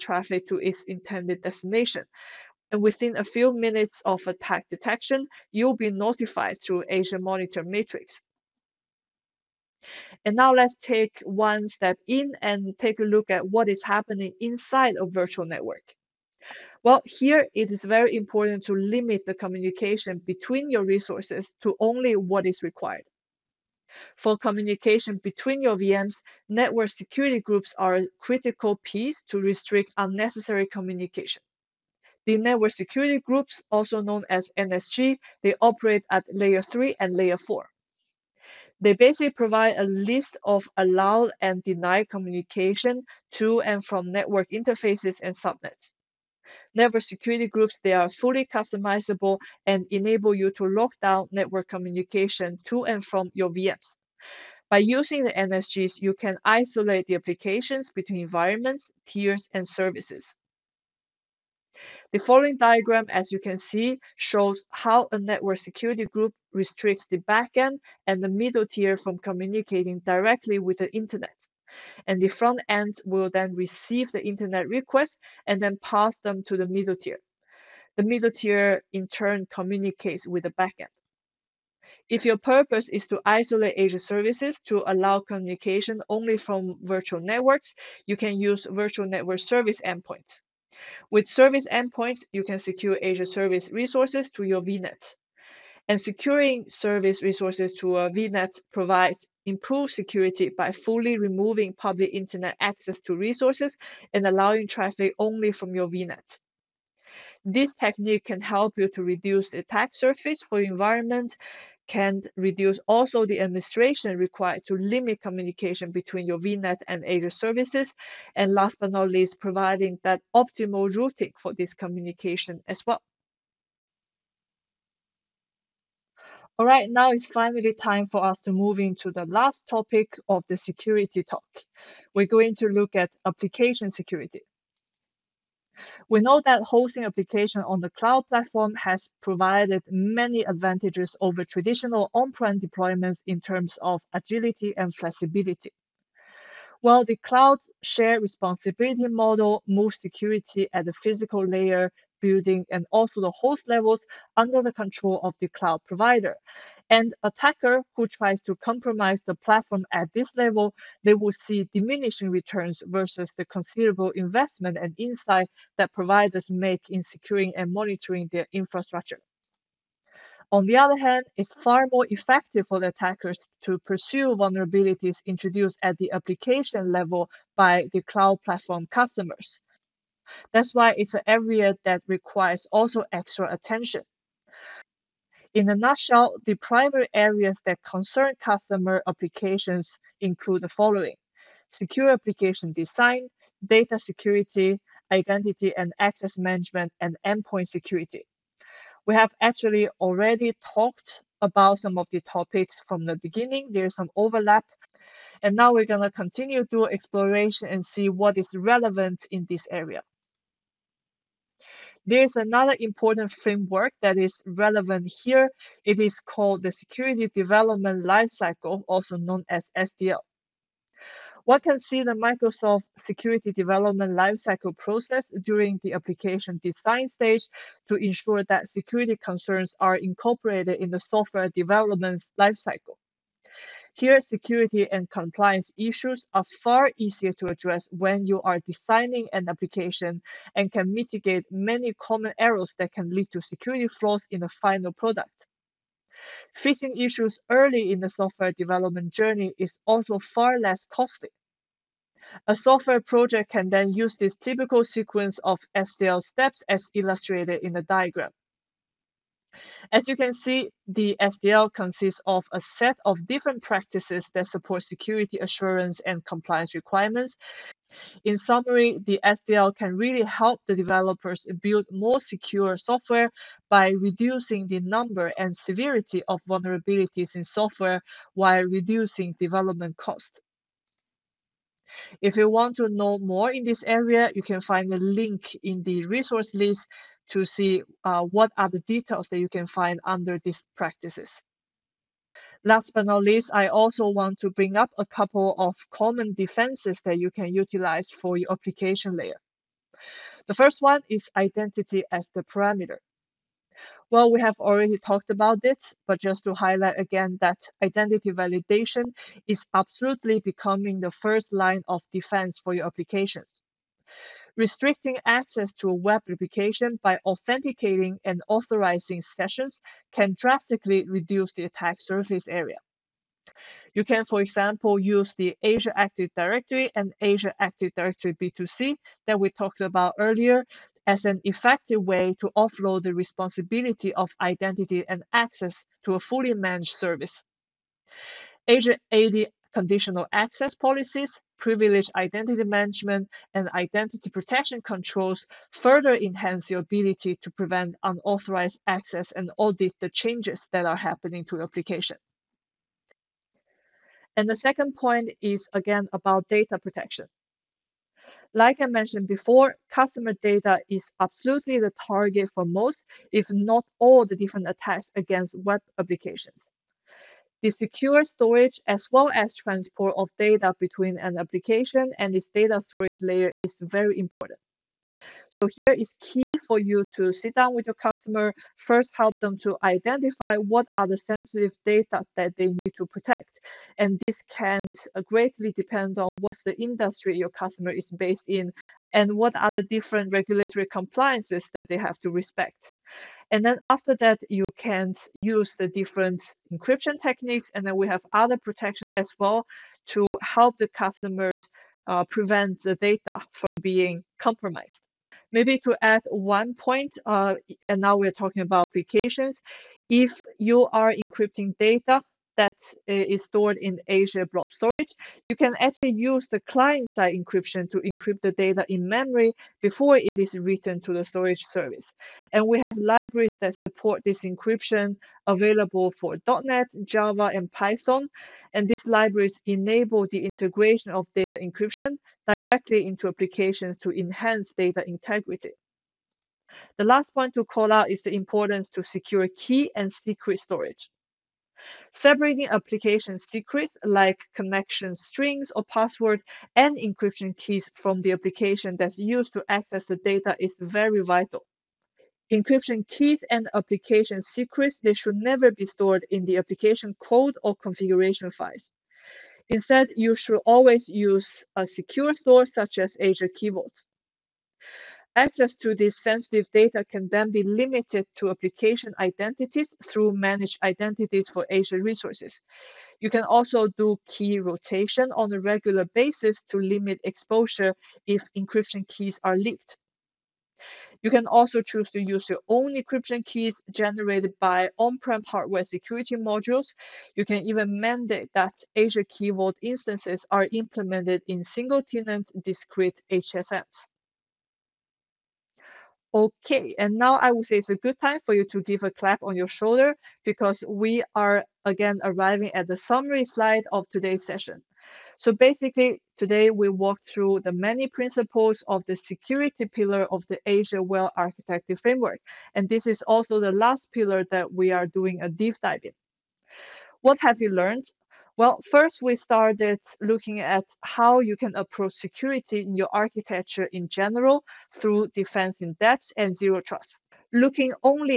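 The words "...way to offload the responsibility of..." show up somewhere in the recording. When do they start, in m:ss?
5:32.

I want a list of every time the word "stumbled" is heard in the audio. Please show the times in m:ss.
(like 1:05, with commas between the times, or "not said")
not said.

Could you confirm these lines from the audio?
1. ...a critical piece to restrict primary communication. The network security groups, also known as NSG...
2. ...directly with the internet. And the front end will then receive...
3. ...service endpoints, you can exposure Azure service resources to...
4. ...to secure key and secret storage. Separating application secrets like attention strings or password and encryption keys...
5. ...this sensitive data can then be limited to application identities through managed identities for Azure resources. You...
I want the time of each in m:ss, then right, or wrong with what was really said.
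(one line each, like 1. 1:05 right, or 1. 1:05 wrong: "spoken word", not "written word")
1. 0:27 wrong: "unnecessary", not "primary"
2. 1:09 right
3. 1:31 wrong: "secure", not "exposure"
4. 7:18 wrong: "connection", not "attention"
5. 7:45 right.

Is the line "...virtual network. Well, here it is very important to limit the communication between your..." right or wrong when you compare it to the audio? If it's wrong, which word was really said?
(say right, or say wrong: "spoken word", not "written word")
right.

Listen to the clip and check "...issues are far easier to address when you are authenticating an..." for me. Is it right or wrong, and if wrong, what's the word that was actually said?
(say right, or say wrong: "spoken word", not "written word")
wrong: "designing", not "authenticating".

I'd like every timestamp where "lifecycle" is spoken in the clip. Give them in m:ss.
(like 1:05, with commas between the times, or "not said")
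3:38, 3:44, 3:52.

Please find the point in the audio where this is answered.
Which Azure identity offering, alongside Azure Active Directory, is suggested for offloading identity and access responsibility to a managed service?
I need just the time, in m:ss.
5:27.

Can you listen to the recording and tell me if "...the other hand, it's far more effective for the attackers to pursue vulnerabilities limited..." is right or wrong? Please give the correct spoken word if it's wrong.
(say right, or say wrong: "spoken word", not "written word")
wrong: "introduced", not "limited".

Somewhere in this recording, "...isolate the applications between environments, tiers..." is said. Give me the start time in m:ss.
0:56.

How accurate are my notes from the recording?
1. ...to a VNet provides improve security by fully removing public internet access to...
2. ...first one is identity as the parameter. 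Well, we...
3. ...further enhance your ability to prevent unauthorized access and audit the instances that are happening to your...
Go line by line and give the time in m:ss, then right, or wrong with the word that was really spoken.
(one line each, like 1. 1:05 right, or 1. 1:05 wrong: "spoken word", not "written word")
1. 1:37 right
2. 5:00 right
3. 5:45 wrong: "changes", not "instances".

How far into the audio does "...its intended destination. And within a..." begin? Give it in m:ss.
0:00.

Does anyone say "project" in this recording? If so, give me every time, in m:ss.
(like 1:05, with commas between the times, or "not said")
4:12.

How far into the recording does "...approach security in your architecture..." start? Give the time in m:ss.
8:41.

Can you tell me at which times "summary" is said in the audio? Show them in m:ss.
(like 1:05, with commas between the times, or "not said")
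4:28, 8:22.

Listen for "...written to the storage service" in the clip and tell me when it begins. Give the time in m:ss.
7:00.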